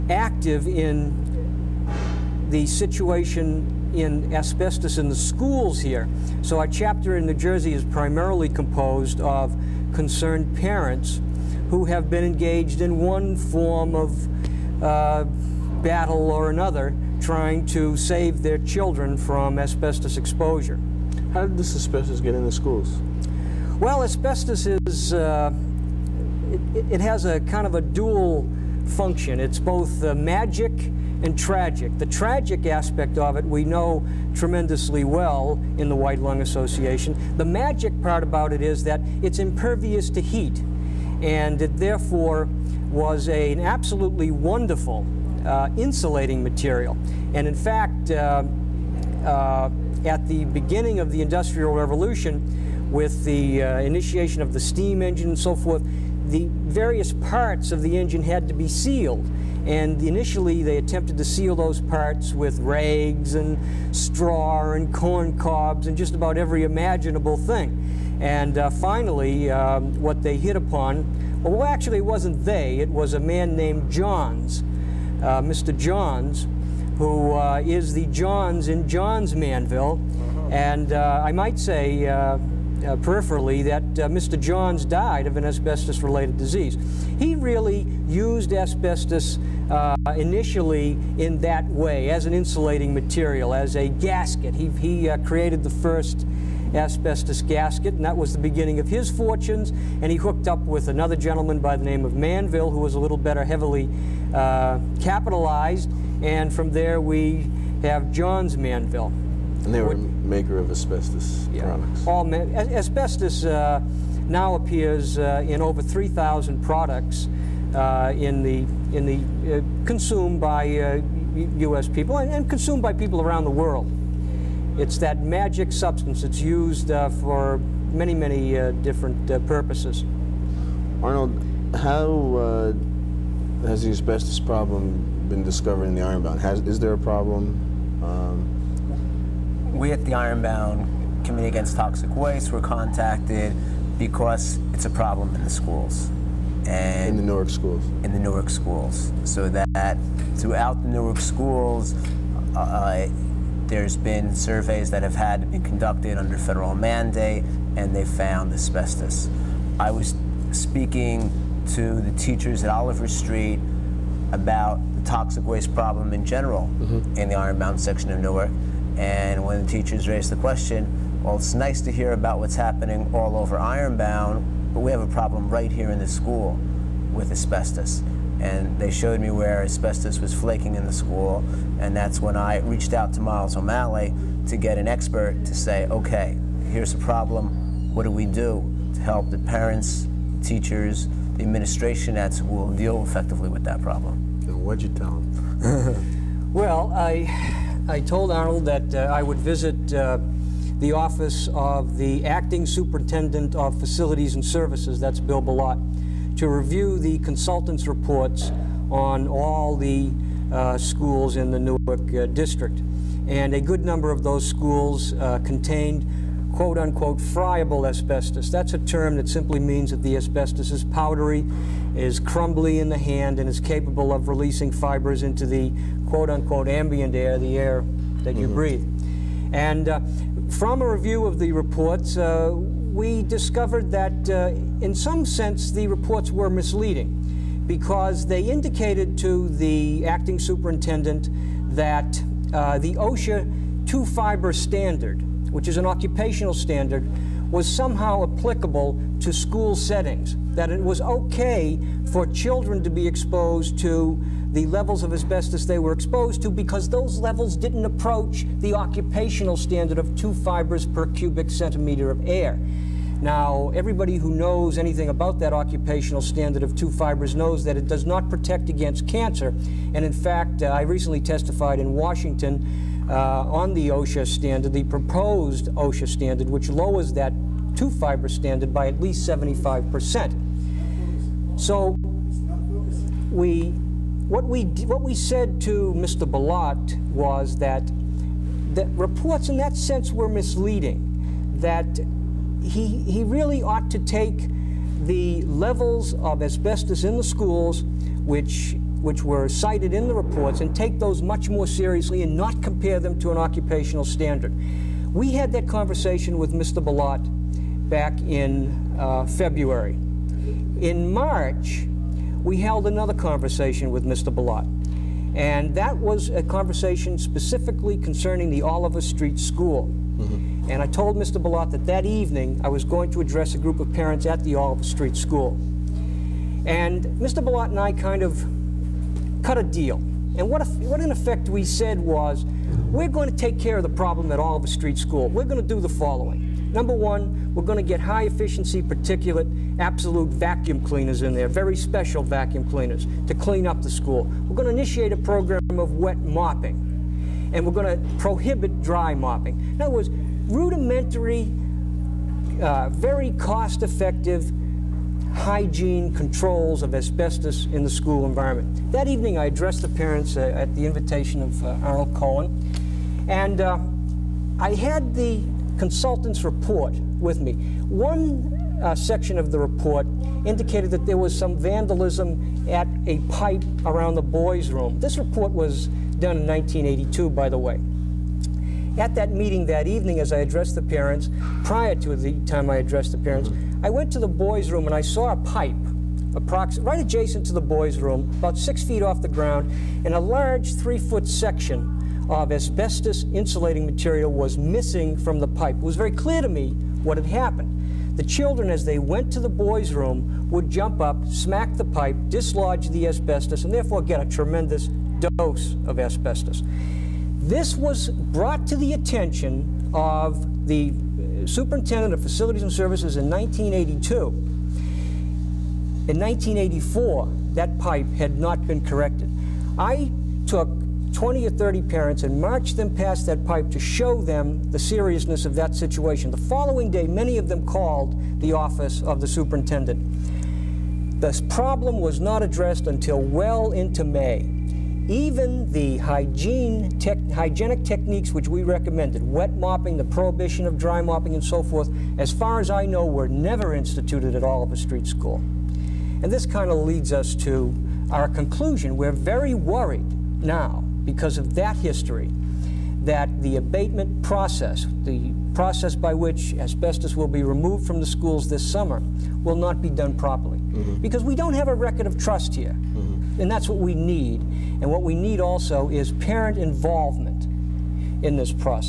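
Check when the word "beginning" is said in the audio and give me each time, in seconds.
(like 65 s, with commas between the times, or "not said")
50 s, 98 s.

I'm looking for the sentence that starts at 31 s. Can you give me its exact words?
The tragic aspect of it we know tremendously well in the White Lung Association.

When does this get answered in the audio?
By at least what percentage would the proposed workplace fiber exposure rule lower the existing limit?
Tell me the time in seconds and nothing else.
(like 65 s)
279 s.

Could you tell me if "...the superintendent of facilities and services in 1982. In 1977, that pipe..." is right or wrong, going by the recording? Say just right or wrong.
wrong.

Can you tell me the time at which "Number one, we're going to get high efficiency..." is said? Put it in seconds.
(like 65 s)
336 s.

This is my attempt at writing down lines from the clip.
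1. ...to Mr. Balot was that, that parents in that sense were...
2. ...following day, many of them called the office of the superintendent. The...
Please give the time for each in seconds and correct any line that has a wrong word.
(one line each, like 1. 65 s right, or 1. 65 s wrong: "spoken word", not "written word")
1. 285 s wrong: "reports", not "parents"
2. 426 s right.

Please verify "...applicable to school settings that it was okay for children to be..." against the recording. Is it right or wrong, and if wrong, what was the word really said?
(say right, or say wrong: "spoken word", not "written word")
right.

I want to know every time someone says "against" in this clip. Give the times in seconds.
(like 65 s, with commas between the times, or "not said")
141 s, 268 s.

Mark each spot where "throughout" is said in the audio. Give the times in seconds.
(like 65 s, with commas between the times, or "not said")
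150 s.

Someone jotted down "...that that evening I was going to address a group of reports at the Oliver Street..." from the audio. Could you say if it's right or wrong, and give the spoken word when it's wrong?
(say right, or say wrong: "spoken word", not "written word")
wrong: "parents", not "reports".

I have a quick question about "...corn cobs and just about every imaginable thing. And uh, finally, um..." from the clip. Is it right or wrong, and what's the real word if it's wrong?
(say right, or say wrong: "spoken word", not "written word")
right.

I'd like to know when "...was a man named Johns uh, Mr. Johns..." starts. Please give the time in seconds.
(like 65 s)
72 s.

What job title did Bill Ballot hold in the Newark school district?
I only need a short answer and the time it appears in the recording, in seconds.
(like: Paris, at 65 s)
acting superintendent of facilities and services, at 202 s.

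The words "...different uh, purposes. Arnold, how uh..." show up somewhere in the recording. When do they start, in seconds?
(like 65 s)
128 s.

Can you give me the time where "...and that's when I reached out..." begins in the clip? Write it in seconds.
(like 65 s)
181 s.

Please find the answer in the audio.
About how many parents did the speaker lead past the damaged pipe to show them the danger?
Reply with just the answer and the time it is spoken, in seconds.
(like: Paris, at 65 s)
20 or 30, at 421 s.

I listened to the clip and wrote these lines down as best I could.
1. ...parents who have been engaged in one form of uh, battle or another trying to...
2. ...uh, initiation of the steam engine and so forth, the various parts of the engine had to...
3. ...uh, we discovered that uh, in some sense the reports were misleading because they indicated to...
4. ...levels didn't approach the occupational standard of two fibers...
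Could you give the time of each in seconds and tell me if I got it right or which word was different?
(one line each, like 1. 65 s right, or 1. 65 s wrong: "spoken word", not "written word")
1. 10 s right
2. 53 s right
3. 232 s right
4. 257 s right.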